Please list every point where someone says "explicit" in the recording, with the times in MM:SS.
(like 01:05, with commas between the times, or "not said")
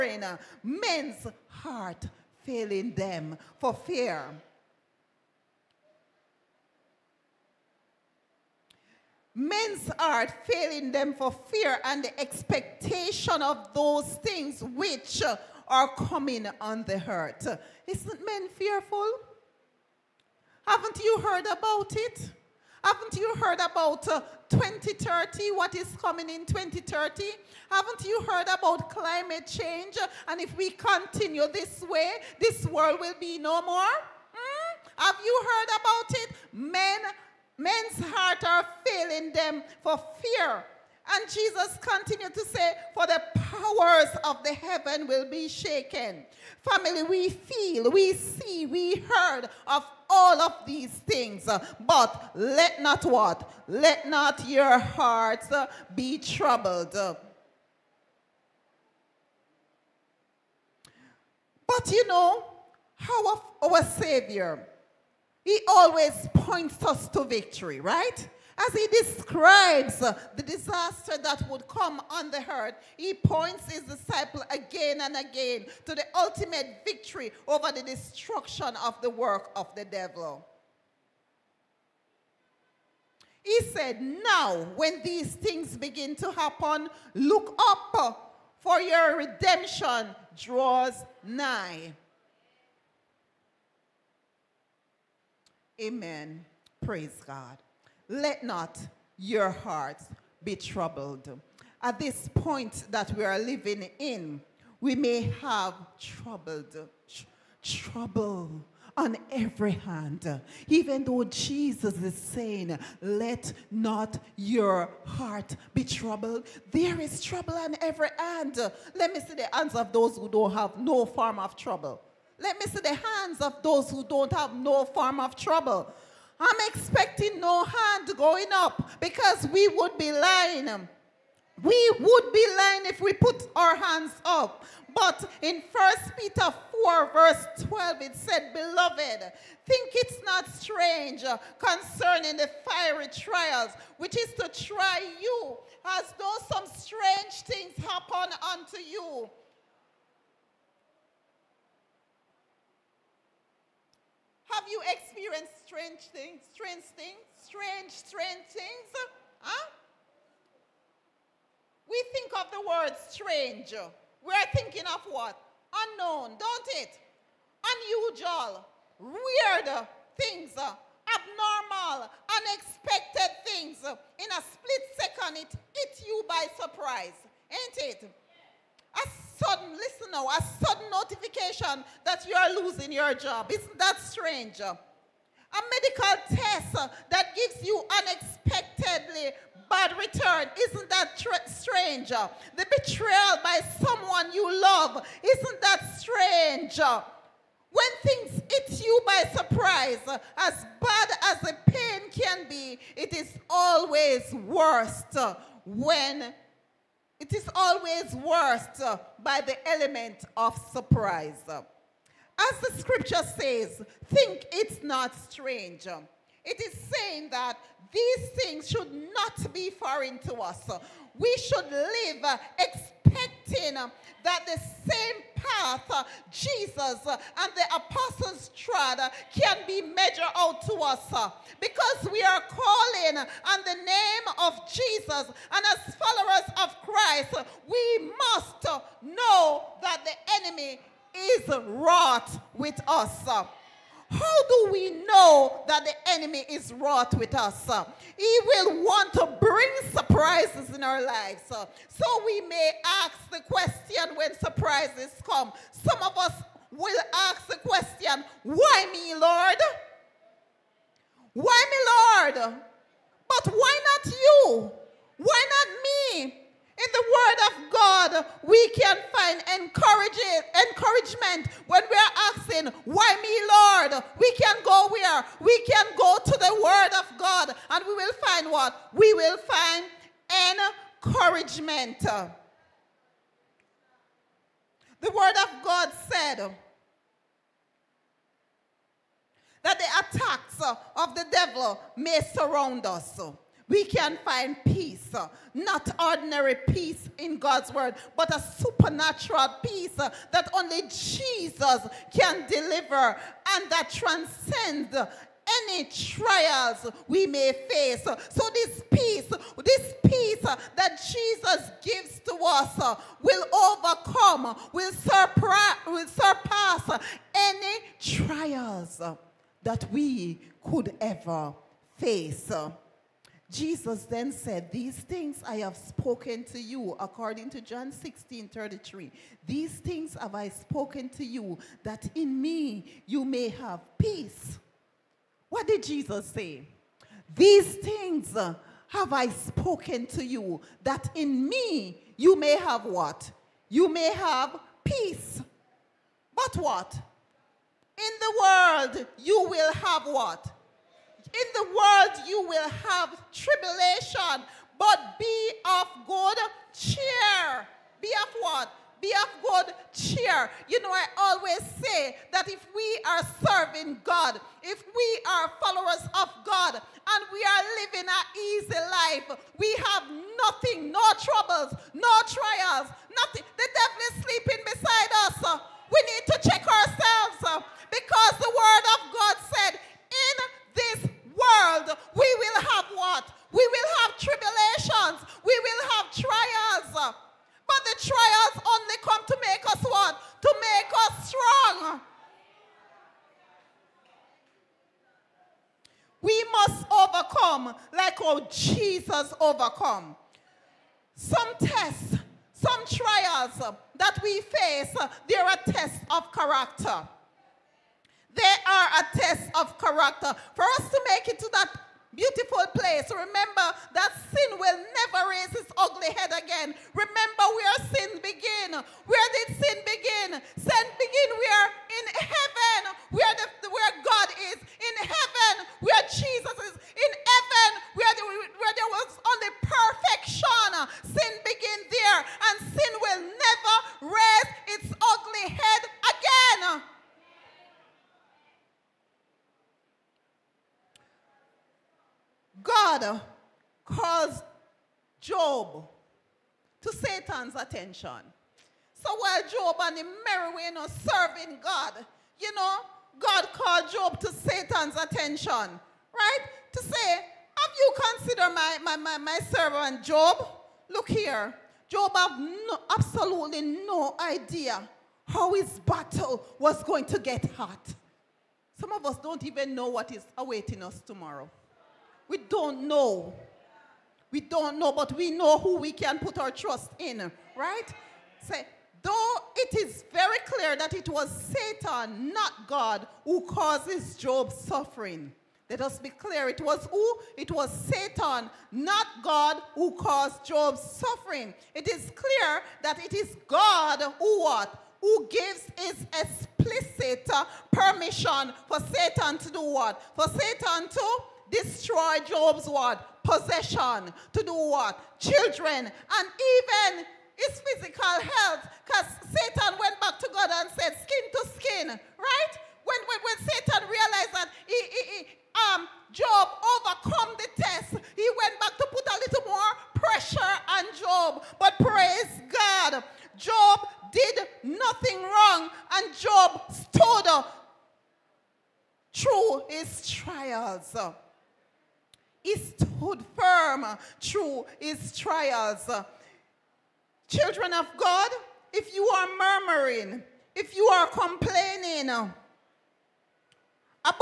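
08:16.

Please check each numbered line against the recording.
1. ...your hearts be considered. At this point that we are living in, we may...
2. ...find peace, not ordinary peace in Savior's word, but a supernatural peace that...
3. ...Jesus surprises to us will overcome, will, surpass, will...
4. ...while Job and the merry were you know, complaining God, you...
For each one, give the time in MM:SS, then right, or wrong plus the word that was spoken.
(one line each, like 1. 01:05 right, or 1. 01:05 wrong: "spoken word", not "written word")
1. 01:39 wrong: "troubled", not "considered"
2. 04:54 wrong: "God", not "Savior"
3. 05:10 wrong: "gives", not "surprises"
4. 07:29 wrong: "serving", not "complaining".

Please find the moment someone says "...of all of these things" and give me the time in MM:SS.
00:49.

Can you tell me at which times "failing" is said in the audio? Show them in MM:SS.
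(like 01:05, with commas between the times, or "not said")
00:02, 00:10, 00:38.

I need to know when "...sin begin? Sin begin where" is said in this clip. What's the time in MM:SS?
06:59.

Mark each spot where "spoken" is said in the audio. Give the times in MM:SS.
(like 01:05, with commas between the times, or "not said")
05:25, 05:30, 05:39.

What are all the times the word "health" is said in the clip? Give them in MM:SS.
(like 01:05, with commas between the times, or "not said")
08:28.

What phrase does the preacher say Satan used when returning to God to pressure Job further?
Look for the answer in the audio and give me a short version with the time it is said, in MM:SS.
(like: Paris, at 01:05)
Skin to skin, at 08:31.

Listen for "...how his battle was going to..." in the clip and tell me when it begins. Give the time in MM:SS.
07:45.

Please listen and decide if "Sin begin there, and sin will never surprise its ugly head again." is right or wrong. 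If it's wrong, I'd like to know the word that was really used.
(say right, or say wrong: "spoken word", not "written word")
wrong: "raise", not "surprise".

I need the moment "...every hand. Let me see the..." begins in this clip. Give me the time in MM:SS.
01:57.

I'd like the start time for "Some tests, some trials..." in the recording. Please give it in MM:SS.
06:41.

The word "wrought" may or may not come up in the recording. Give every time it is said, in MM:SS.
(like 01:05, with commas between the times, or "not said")
04:01, 04:06.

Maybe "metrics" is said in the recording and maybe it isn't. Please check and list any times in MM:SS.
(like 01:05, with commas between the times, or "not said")
not said.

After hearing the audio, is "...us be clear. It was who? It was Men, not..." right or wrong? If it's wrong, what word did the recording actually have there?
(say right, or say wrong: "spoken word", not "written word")
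wrong: "Satan", not "Men".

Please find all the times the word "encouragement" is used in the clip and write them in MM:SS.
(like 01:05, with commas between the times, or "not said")
04:29, 04:41.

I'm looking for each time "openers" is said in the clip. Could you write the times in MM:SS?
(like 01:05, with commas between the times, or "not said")
not said.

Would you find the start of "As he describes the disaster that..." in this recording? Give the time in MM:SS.
01:08.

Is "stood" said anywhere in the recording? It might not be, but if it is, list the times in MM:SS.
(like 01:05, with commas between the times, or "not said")
08:46, 08:52.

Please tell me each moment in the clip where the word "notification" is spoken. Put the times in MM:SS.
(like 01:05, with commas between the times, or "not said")
03:00.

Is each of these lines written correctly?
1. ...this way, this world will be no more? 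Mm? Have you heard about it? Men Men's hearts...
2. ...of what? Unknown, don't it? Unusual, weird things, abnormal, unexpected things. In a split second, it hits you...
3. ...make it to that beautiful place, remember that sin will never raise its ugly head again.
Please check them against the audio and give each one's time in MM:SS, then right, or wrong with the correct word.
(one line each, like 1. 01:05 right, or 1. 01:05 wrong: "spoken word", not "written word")
1. 00:31 right
2. 02:44 right
3. 06:51 right.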